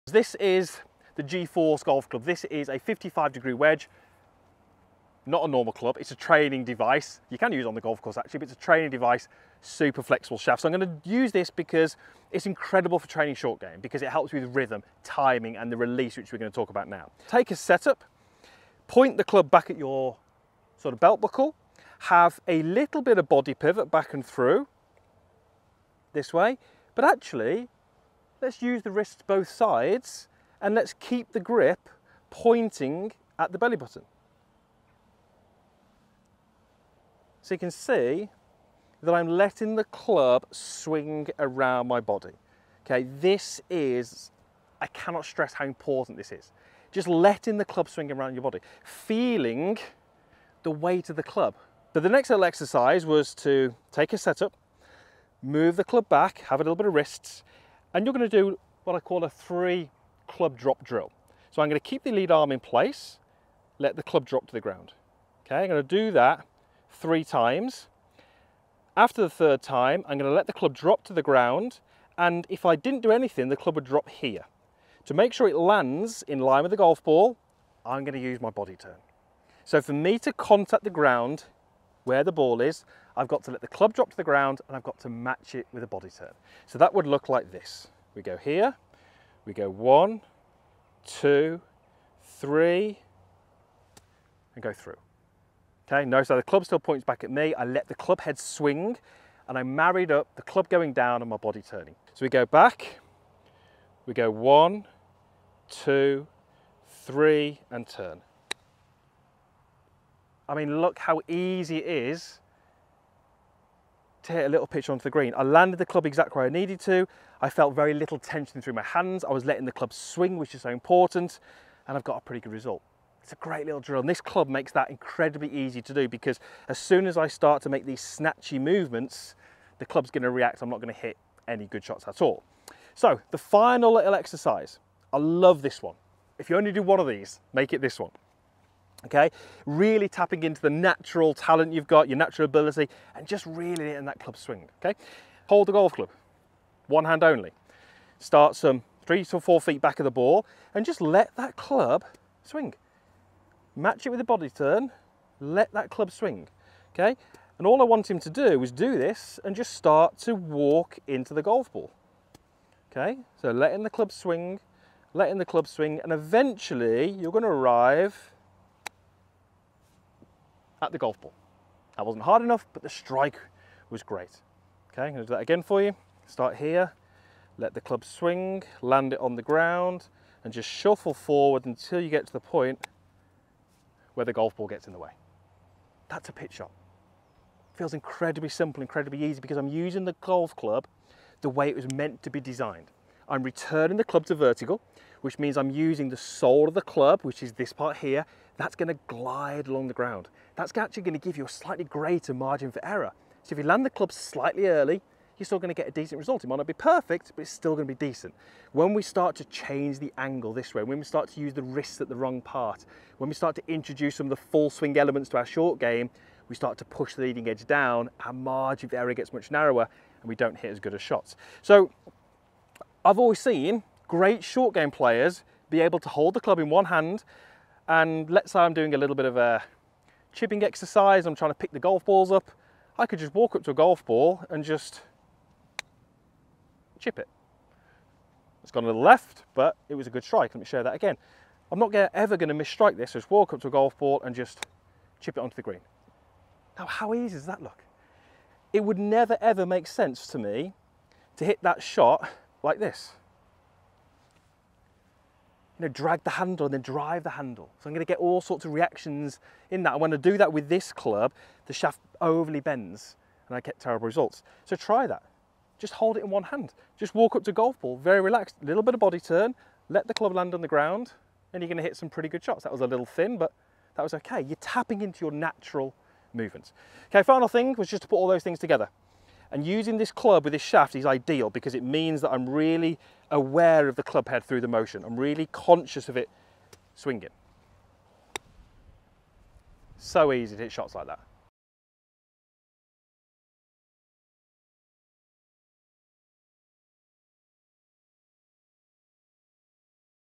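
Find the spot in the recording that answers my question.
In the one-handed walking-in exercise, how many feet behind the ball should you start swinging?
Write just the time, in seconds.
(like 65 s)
149 s.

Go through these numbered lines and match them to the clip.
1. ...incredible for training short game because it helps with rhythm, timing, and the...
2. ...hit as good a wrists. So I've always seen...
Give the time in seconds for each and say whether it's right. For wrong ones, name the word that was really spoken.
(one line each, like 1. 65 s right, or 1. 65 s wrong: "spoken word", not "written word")
1. 12 s right
2. 220 s wrong: "shots", not "wrists".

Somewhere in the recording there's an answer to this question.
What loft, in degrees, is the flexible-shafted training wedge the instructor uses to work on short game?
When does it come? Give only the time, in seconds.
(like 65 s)
2 s.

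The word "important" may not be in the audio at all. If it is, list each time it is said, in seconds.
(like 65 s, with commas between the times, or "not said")
45 s, 120 s.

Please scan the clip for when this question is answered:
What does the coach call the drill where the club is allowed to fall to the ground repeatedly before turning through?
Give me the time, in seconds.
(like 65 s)
59 s.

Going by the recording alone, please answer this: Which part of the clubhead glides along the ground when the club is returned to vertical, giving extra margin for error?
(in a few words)
the sole.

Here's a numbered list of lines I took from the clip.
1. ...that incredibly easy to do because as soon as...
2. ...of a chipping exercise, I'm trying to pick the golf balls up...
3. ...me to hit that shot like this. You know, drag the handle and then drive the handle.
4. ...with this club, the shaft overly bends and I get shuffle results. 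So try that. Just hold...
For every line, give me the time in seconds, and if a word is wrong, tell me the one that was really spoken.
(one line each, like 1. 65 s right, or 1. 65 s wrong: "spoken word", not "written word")
1. 124 s right
2. 229 s right
3. 250 s right
4. 260 s wrong: "terrible", not "shuffle".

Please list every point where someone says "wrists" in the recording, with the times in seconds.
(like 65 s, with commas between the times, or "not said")
28 s, 56 s, 211 s.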